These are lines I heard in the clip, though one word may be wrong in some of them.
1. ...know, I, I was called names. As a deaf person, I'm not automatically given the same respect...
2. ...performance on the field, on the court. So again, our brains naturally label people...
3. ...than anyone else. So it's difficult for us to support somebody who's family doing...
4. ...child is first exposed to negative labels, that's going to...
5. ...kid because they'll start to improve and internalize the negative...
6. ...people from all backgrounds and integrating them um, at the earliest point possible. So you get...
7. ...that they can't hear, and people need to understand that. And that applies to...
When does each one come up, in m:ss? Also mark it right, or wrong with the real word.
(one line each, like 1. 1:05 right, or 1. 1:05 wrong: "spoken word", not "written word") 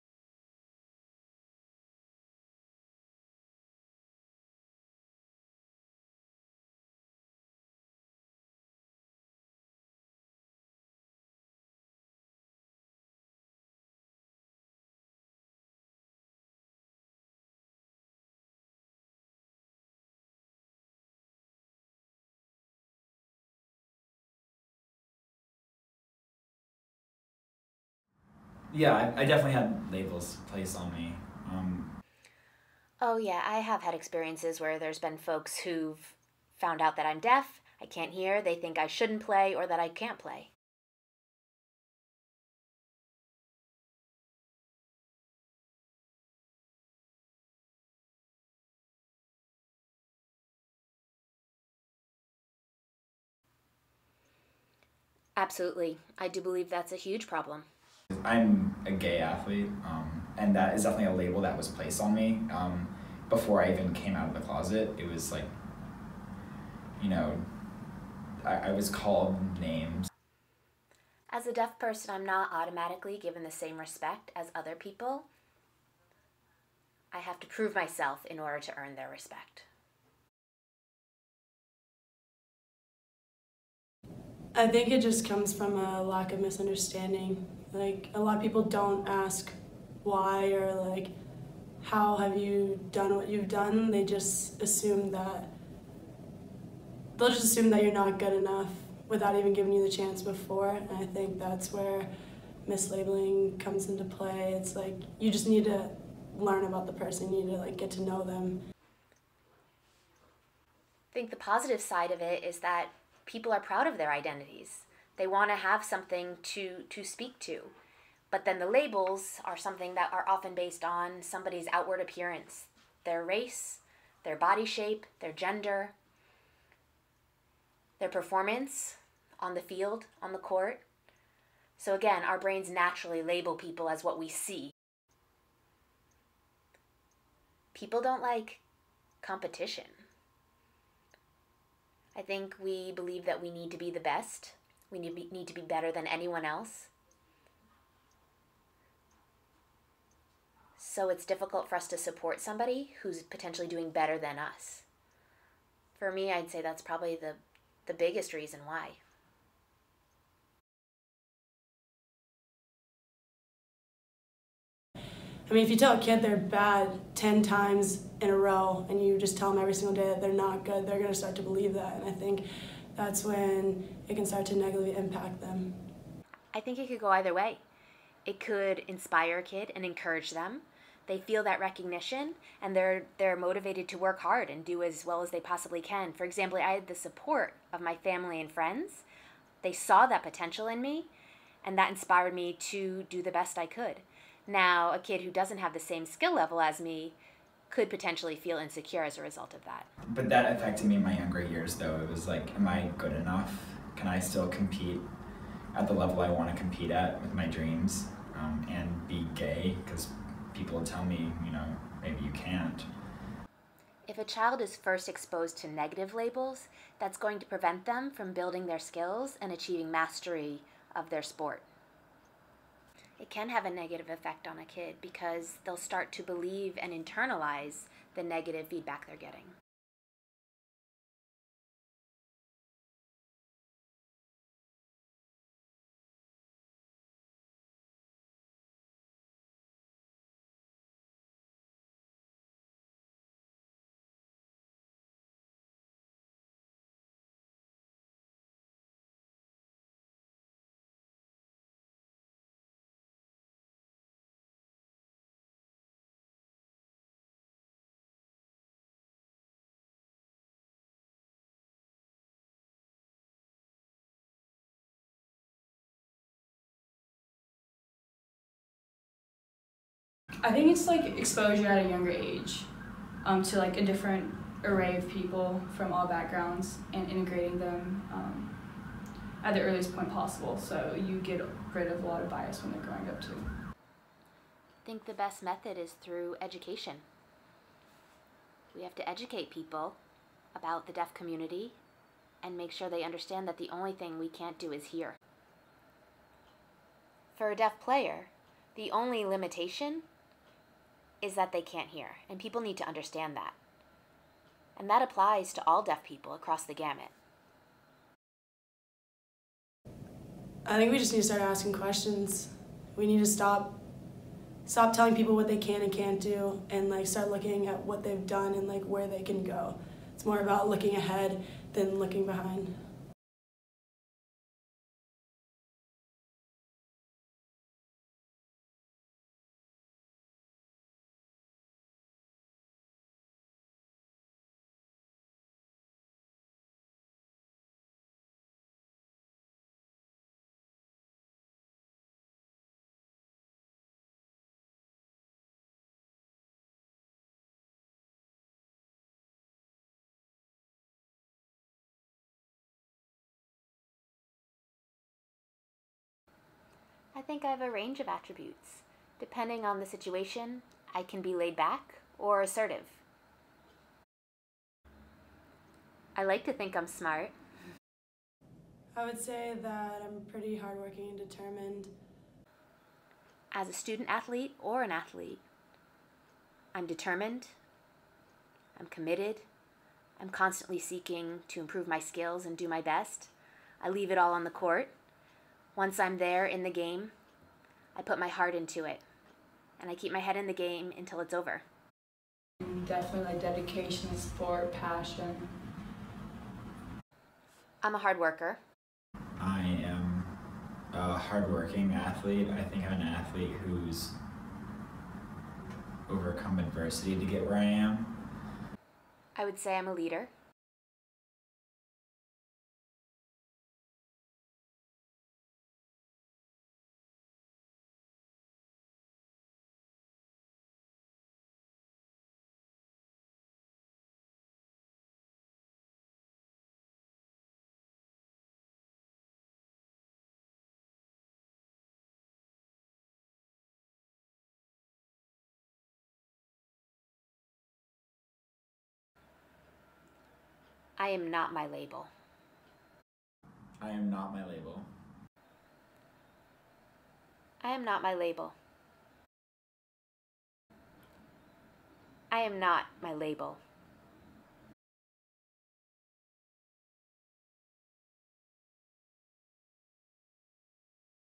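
1. 1:07 right
2. 2:08 right
3. 2:25 wrong: "potentially", not "family"
4. 3:34 right
5. 3:44 wrong: "believe", not "improve"
6. 4:35 right
7. 5:01 right.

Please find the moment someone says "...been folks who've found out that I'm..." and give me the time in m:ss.
0:34.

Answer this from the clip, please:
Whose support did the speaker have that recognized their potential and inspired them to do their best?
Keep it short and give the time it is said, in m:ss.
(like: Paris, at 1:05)
Family and friends, at 3:07.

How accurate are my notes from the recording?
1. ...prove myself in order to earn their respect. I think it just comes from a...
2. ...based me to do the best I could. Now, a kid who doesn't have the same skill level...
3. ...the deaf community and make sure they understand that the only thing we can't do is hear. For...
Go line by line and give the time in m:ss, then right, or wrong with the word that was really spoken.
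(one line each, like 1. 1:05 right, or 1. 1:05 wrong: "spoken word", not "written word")
1. 1:17 right
2. 3:11 wrong: "inspired", not "based"
3. 4:50 right.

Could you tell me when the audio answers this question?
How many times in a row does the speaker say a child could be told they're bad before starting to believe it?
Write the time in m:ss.
2:47.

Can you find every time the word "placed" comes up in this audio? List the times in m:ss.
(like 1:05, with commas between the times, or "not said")
0:30, 1:01.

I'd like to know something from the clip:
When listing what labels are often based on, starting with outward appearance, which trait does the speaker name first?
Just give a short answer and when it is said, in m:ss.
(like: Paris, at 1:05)
Race, at 2:03.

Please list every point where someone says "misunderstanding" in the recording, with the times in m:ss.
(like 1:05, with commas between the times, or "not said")
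1:26.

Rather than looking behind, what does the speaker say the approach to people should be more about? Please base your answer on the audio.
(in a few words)
Looking ahead.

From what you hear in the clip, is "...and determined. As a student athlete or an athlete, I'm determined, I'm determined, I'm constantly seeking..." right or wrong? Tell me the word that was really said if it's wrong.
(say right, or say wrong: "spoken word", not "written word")
wrong: "committed", not "determined".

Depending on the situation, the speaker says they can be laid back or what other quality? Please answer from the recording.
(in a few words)
Assertive.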